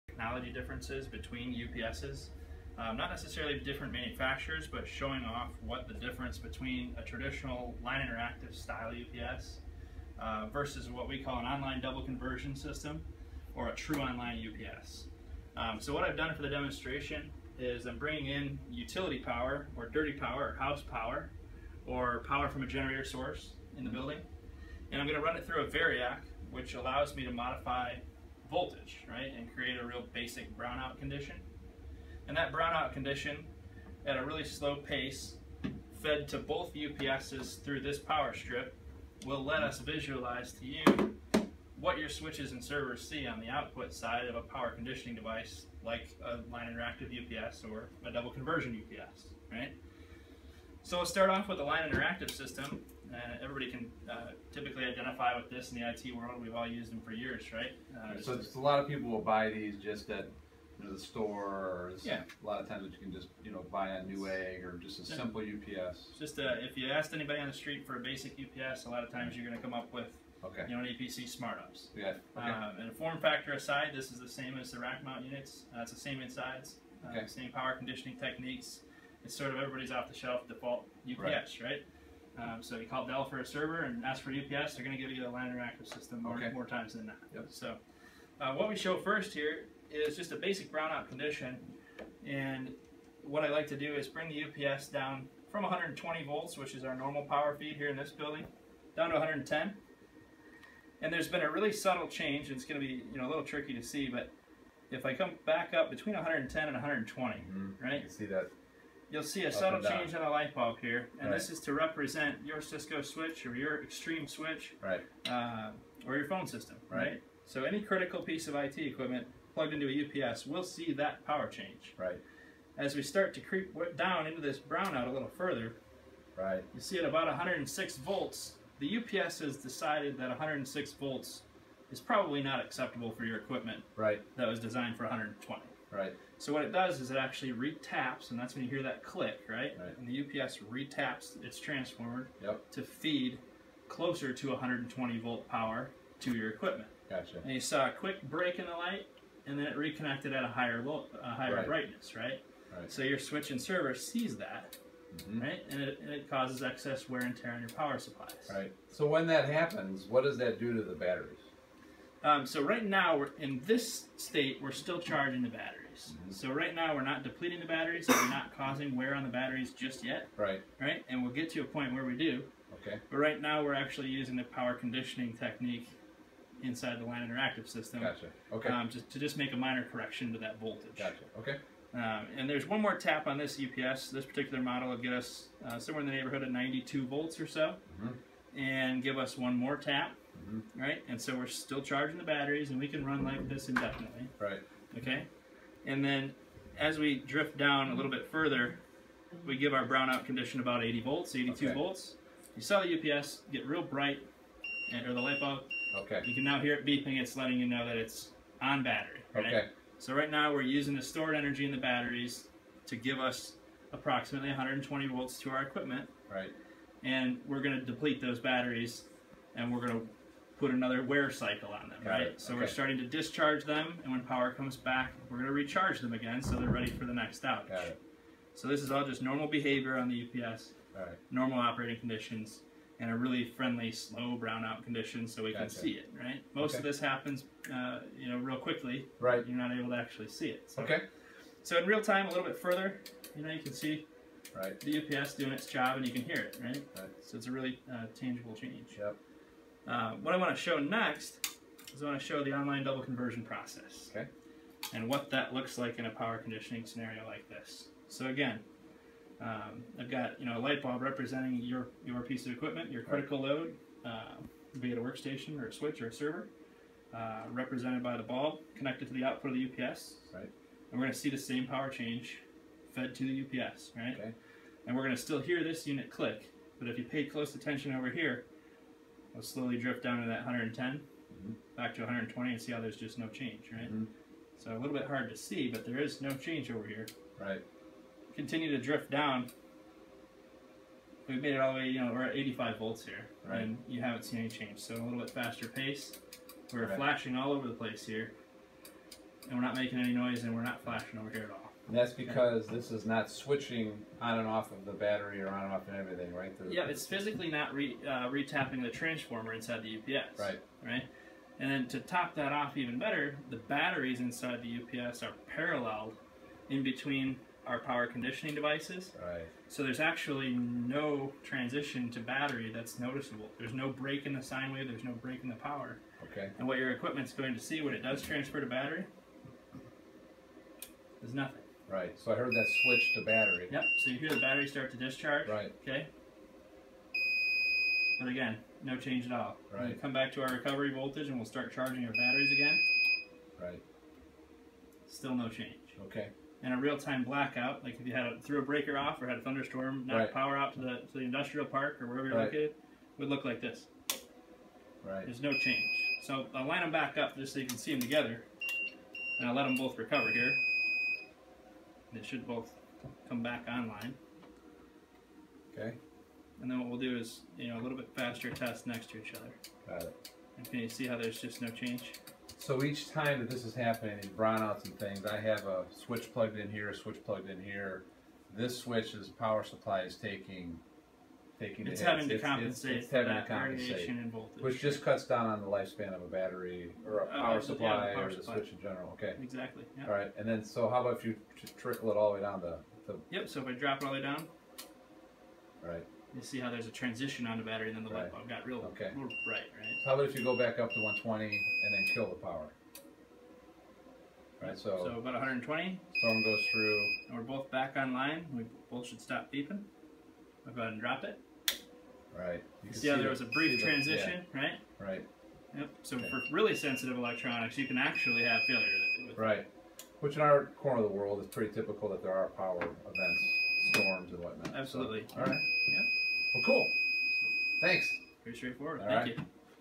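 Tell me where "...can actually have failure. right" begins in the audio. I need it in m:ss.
6:57.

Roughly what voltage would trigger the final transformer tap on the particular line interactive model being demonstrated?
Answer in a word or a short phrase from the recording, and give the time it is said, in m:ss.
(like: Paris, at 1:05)
92 volts, at 3:06.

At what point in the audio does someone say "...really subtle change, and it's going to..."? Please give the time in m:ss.
1:41.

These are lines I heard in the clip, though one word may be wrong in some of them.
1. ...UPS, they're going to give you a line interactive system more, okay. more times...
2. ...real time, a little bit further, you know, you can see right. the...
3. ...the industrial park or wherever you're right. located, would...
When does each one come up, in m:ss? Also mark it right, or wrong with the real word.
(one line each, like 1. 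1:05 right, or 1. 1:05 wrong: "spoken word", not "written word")
1. 1:24 right
2. 4:01 right
3. 5:51 right.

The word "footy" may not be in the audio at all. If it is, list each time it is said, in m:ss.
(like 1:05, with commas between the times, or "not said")
not said.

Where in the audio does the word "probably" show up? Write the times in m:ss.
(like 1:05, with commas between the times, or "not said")
2:11.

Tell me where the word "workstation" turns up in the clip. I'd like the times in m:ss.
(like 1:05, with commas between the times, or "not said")
4:25.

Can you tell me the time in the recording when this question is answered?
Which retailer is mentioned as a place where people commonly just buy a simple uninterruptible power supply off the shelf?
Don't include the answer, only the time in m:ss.
1:04.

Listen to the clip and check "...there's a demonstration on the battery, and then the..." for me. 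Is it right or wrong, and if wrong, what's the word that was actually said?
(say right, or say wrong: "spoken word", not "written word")
wrong: "transition", not "demonstration".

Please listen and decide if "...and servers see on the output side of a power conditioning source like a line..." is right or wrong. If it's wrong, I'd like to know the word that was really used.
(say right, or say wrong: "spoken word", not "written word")
wrong: "device", not "source".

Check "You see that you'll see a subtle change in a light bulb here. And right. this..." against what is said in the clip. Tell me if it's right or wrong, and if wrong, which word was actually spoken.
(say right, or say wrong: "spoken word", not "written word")
right.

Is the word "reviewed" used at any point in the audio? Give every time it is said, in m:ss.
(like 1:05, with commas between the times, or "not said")
not said.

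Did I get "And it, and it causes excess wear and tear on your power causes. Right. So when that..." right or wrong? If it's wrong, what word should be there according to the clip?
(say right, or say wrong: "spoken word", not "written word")
wrong: "supplies", not "causes".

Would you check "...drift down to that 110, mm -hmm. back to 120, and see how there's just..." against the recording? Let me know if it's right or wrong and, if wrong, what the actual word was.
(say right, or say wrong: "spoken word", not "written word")
right.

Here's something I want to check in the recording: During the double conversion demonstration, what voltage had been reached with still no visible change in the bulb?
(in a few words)
85 volts.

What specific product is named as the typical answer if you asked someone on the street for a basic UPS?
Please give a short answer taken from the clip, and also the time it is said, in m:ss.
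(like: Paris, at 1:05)
APC SmartUPS, at 1:10.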